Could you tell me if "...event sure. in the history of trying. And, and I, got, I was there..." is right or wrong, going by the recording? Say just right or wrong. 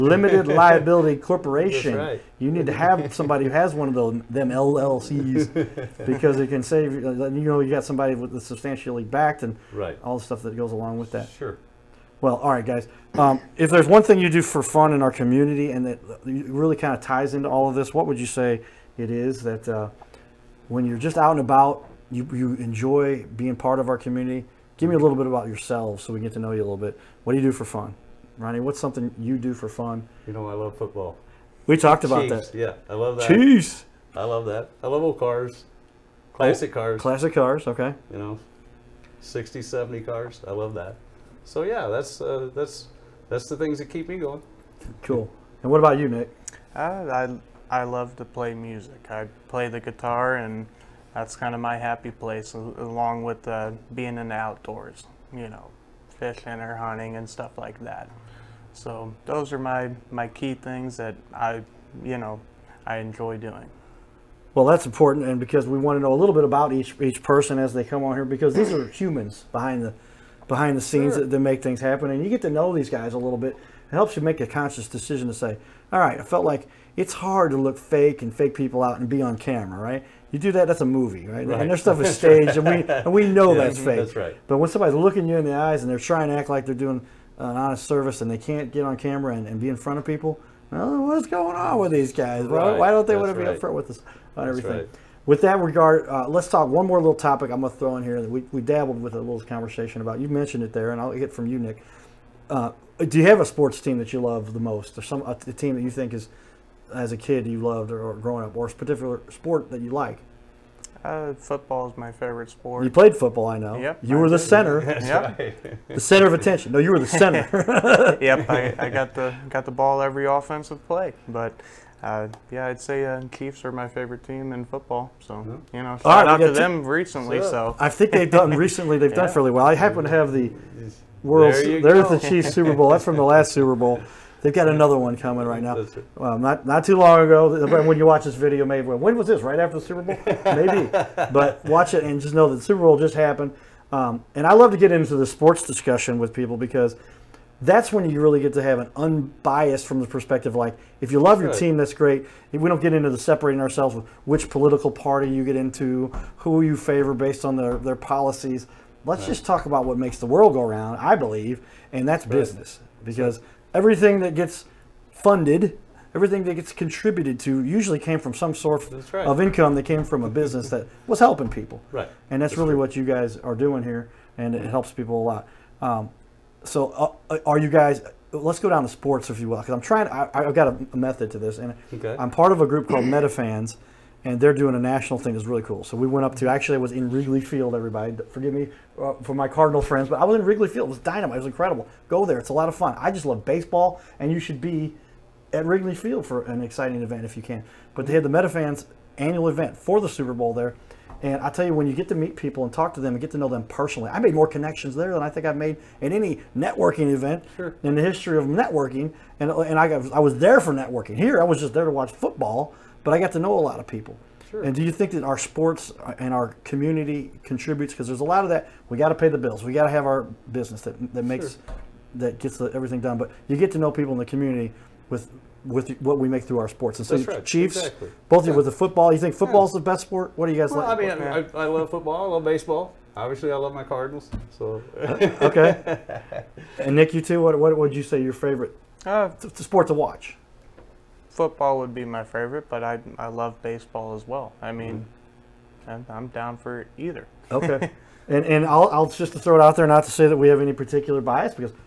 wrong.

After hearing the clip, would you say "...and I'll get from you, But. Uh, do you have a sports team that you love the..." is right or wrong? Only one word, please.
wrong.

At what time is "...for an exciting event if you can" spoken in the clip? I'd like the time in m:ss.
3:16.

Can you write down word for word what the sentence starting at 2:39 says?
just talk about what makes the world go around.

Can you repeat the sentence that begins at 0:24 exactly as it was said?
Give me a little bit about yourselves so we get to know you a little bit.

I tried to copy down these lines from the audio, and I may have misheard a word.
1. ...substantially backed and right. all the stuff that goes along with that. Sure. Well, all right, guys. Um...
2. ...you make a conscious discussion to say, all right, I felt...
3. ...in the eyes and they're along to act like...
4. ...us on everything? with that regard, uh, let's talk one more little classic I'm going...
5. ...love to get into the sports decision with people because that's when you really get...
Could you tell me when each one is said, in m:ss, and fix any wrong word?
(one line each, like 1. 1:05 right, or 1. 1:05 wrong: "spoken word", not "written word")
1. 0:08 right
2. 1:14 wrong: "decision", not "discussion"
3. 1:25 wrong: "trying", not "along"
4. 1:33 wrong: "topic", not "classic"
5. 2:24 wrong: "discussion", not "decision".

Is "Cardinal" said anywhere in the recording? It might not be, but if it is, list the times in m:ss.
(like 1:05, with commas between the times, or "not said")
3:09, 3:53.